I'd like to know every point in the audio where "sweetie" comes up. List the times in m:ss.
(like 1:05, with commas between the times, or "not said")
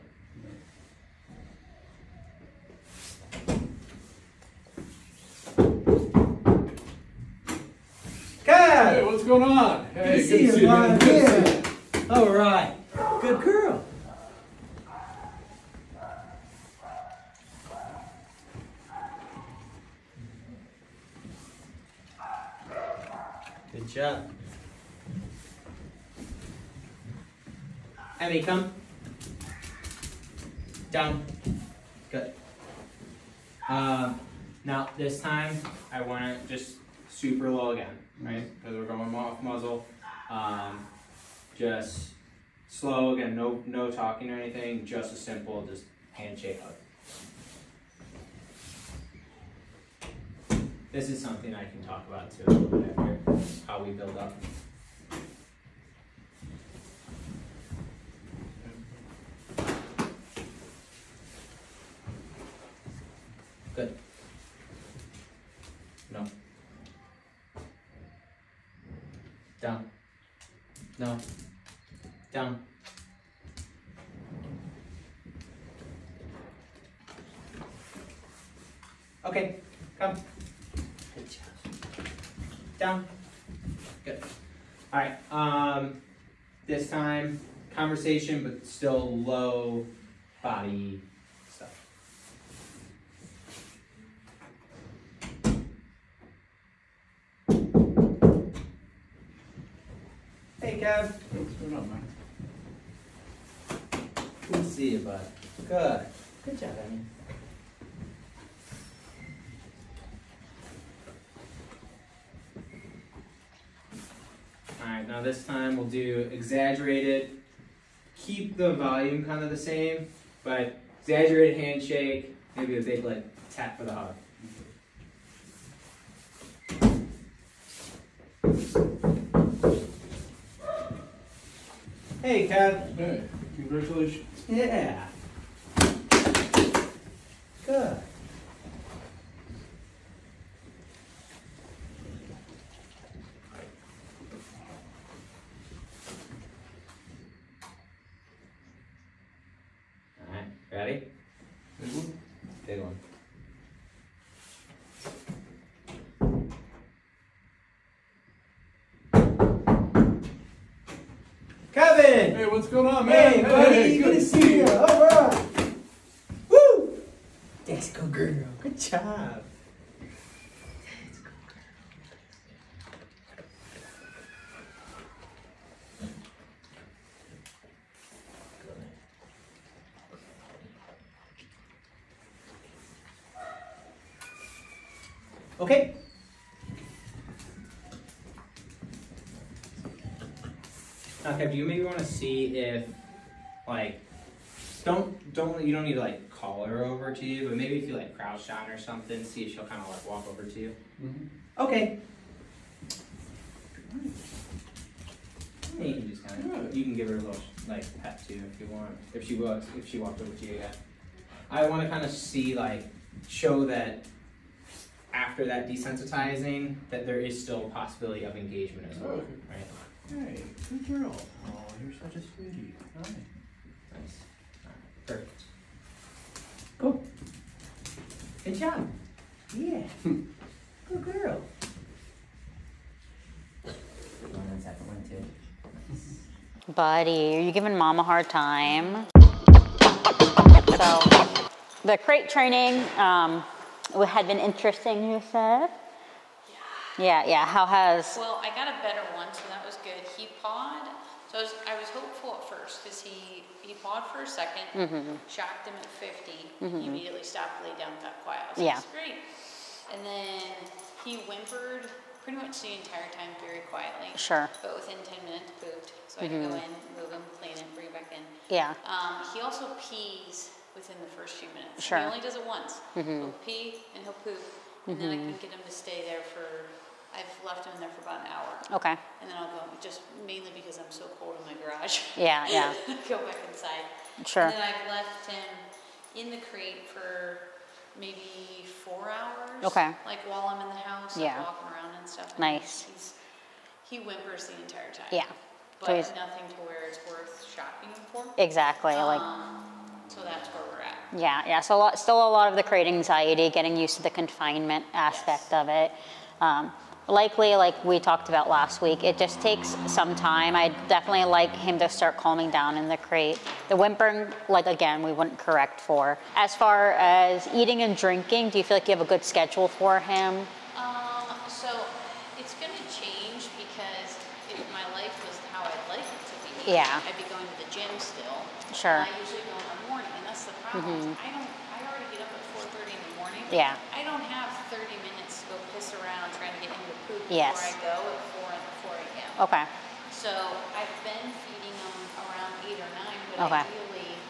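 3:42.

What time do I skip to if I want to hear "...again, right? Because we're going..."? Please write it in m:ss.
0:37.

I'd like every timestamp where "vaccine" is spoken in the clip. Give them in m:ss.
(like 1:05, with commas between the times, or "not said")
not said.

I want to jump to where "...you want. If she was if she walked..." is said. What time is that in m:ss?
3:28.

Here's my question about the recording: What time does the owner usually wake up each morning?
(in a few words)
4:30.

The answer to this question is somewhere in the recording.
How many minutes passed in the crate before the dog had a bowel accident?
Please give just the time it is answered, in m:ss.
4:25.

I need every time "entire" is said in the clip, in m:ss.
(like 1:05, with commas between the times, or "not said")
4:22, 4:54.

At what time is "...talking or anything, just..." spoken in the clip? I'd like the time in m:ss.
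0:43.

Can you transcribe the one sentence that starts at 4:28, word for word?
Um, he also pees within the first few minutes.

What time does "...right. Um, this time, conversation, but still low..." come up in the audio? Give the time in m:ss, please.
1:25.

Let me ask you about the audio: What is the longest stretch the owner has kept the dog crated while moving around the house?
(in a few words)
4 hours.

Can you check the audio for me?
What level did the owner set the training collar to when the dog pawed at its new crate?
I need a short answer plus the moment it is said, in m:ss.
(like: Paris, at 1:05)
50, at 4:15.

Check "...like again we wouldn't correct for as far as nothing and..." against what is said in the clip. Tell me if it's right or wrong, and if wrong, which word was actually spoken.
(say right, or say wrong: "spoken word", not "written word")
wrong: "eating", not "nothing".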